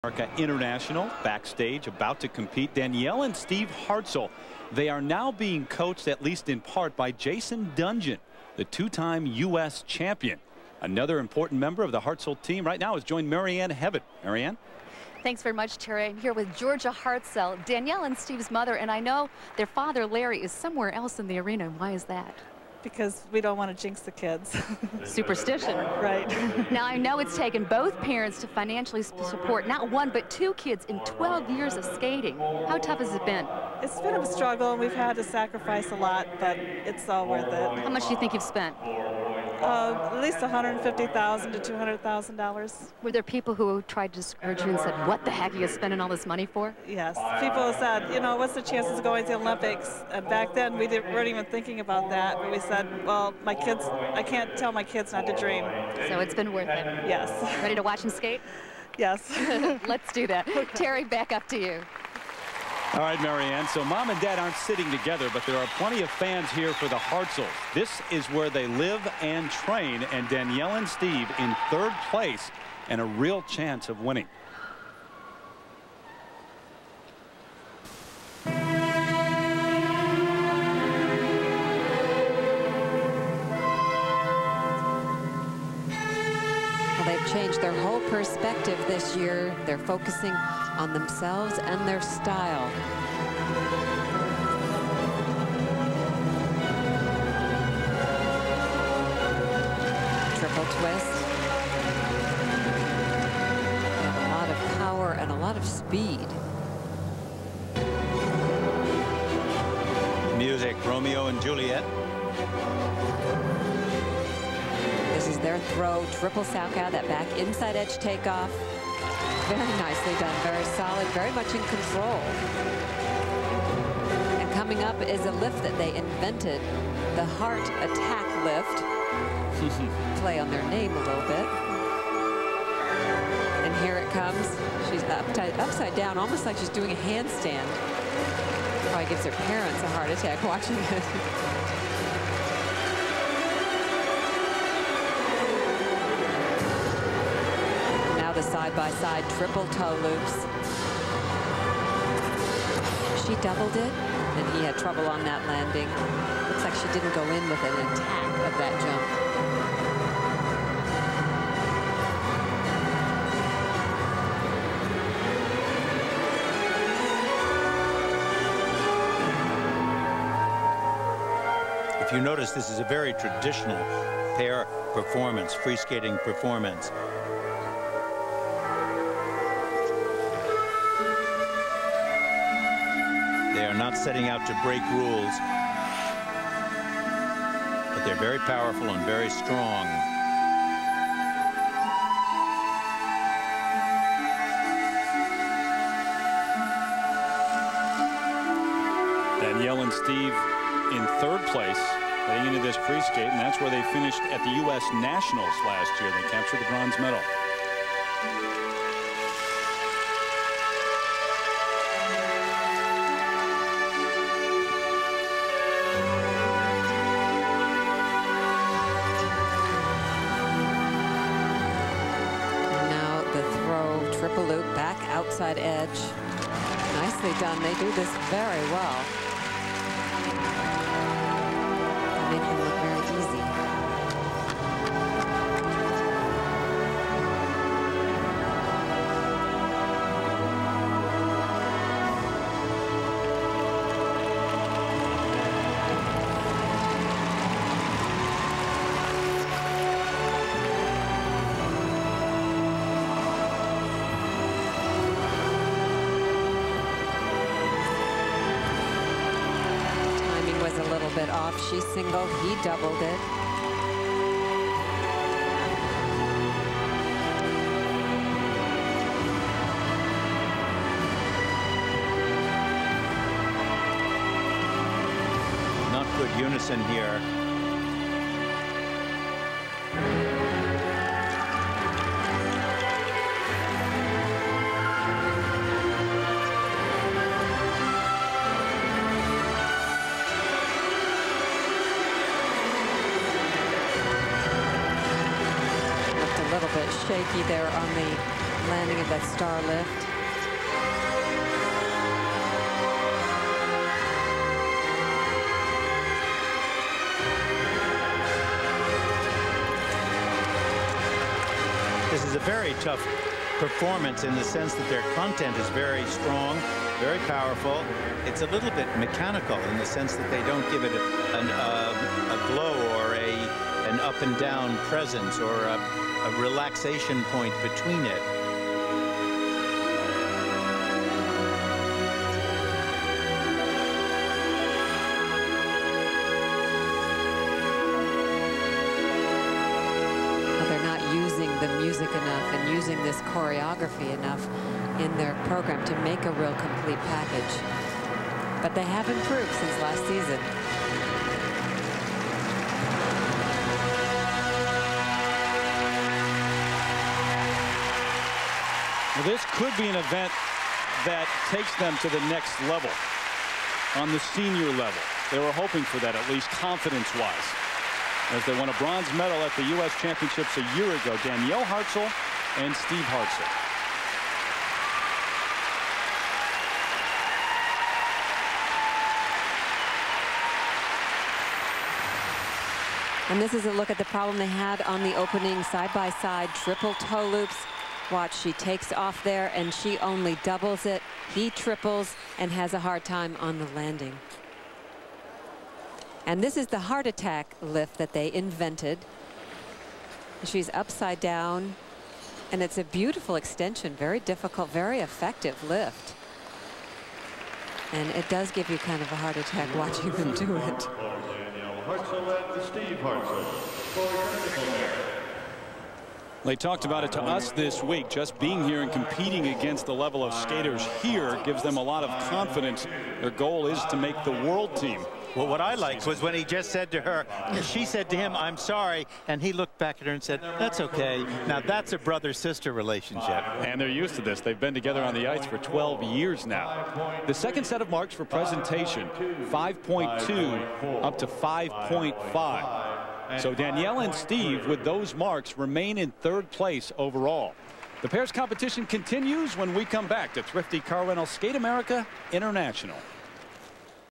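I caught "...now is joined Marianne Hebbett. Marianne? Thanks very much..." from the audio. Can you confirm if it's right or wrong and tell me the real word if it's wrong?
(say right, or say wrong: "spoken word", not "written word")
right.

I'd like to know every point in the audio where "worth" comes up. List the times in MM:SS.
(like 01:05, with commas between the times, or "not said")
00:37, 00:56.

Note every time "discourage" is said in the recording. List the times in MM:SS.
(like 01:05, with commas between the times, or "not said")
00:44.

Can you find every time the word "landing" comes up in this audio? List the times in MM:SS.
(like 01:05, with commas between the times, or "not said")
02:35, 04:58, 06:33.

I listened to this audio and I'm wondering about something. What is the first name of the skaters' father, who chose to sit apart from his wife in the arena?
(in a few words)
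Larry.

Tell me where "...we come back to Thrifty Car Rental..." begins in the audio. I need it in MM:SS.
07:29.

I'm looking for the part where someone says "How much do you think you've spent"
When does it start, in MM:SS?
00:37.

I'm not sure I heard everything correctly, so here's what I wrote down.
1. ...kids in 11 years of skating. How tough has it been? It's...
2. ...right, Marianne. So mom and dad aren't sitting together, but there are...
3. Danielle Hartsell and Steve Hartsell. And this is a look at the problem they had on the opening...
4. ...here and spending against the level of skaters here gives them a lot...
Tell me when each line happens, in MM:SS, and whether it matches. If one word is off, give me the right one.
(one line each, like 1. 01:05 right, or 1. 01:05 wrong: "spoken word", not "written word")
1. 00:30 wrong: "12", not "11"
2. 01:02 right
3. 06:11 right
4. 06:58 wrong: "competing", not "spending".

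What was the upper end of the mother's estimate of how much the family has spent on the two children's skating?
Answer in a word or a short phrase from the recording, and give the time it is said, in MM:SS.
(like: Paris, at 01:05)
$200,000, at 00:41.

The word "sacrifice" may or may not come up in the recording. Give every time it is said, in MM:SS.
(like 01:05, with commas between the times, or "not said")
00:35.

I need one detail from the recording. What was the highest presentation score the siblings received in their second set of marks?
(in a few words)
5.5.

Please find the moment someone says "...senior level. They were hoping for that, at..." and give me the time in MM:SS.
06:04.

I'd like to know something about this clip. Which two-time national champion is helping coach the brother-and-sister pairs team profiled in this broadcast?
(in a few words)
Jason Dungjen.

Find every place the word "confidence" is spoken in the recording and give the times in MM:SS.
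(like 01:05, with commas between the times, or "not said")
06:06, 07:02.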